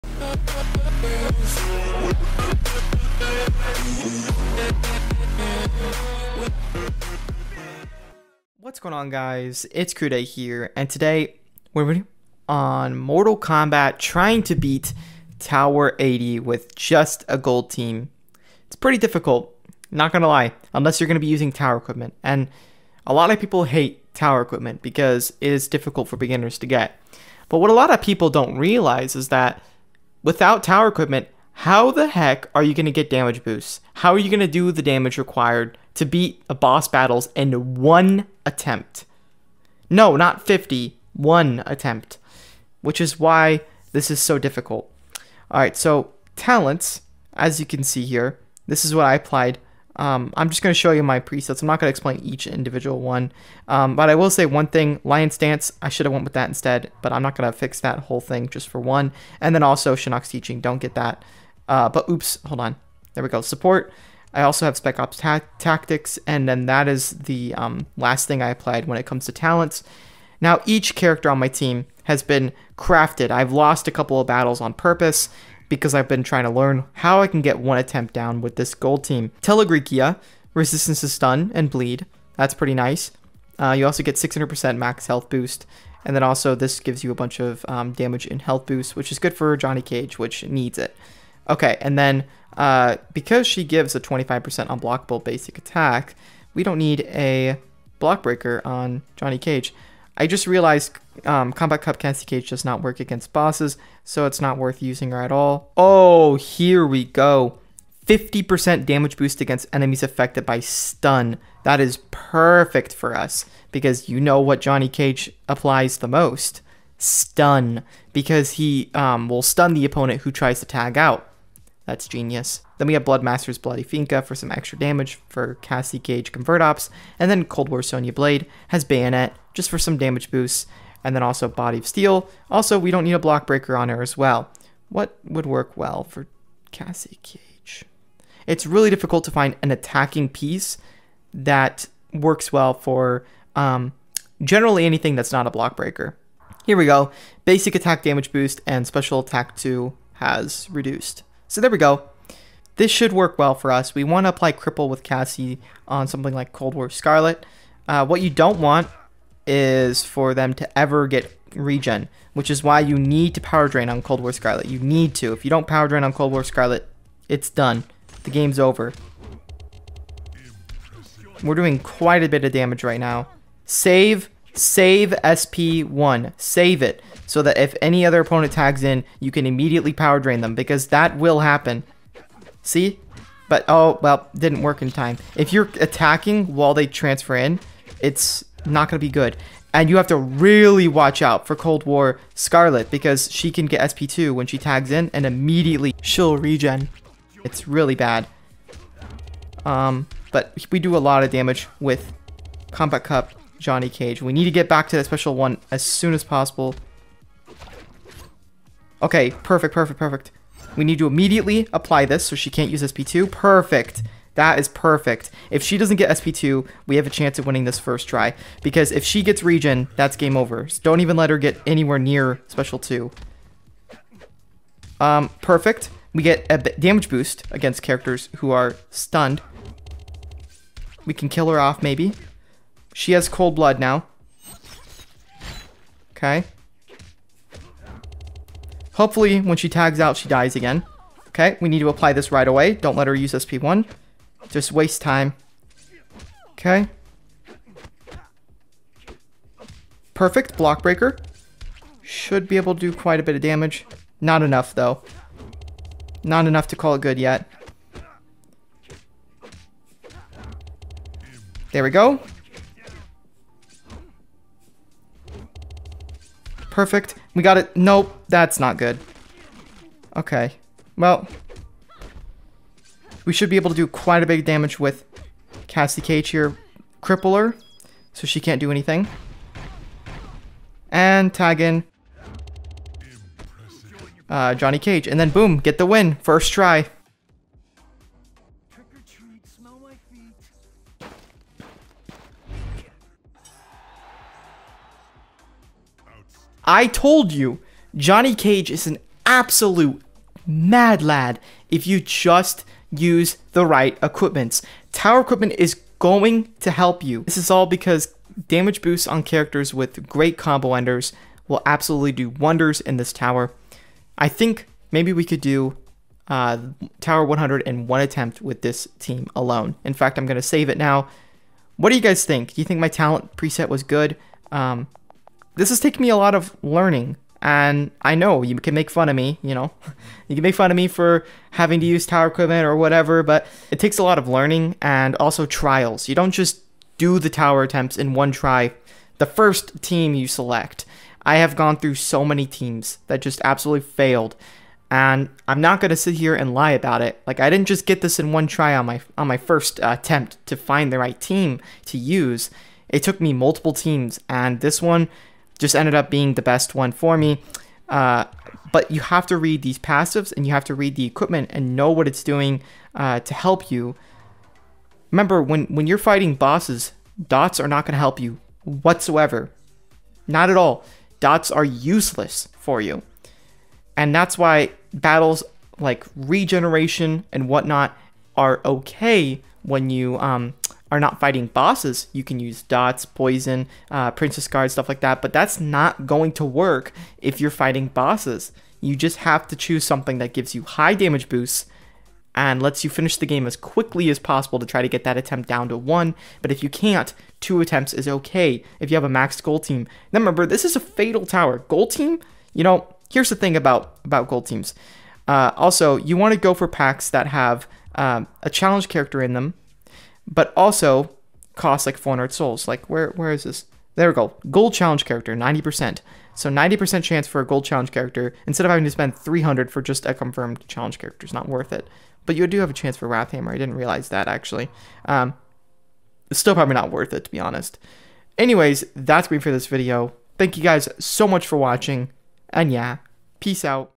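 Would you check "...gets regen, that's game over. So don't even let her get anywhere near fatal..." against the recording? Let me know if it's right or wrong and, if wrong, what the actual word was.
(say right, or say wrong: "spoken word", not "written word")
wrong: "special", not "fatal".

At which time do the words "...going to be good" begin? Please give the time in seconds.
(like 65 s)
188 s.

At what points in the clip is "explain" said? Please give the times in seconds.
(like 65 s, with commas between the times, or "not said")
51 s.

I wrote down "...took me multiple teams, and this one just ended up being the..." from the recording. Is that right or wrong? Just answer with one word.
right.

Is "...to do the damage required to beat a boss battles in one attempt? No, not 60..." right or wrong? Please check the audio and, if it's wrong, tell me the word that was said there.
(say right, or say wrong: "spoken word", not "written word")
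wrong: "50", not "60".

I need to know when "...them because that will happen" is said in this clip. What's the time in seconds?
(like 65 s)
180 s.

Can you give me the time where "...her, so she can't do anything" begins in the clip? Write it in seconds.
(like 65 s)
277 s.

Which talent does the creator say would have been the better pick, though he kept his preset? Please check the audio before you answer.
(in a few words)
Lion's Dance.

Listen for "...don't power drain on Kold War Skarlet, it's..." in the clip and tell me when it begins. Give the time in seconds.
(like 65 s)
165 s.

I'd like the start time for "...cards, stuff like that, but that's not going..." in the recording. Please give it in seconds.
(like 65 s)
384 s.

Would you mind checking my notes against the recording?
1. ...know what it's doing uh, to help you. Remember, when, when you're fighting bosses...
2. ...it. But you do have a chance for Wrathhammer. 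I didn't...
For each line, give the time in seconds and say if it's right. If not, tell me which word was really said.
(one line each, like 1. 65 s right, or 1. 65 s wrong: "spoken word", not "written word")
1. 361 s right
2. 421 s right.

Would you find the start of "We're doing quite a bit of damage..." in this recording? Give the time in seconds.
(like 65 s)
171 s.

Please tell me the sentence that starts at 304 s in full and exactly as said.
Tower equipment is going to help you.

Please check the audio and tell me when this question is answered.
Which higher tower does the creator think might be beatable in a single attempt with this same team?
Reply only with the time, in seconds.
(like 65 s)
316 s.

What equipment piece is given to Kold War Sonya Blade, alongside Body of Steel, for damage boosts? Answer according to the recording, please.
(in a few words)
Bayonet.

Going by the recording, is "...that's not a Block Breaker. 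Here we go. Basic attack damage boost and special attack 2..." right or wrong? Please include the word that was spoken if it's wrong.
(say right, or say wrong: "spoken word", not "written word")
right.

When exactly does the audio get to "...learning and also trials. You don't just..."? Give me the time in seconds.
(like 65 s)
334 s.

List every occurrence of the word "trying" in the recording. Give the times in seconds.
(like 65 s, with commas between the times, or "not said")
13 s, 76 s.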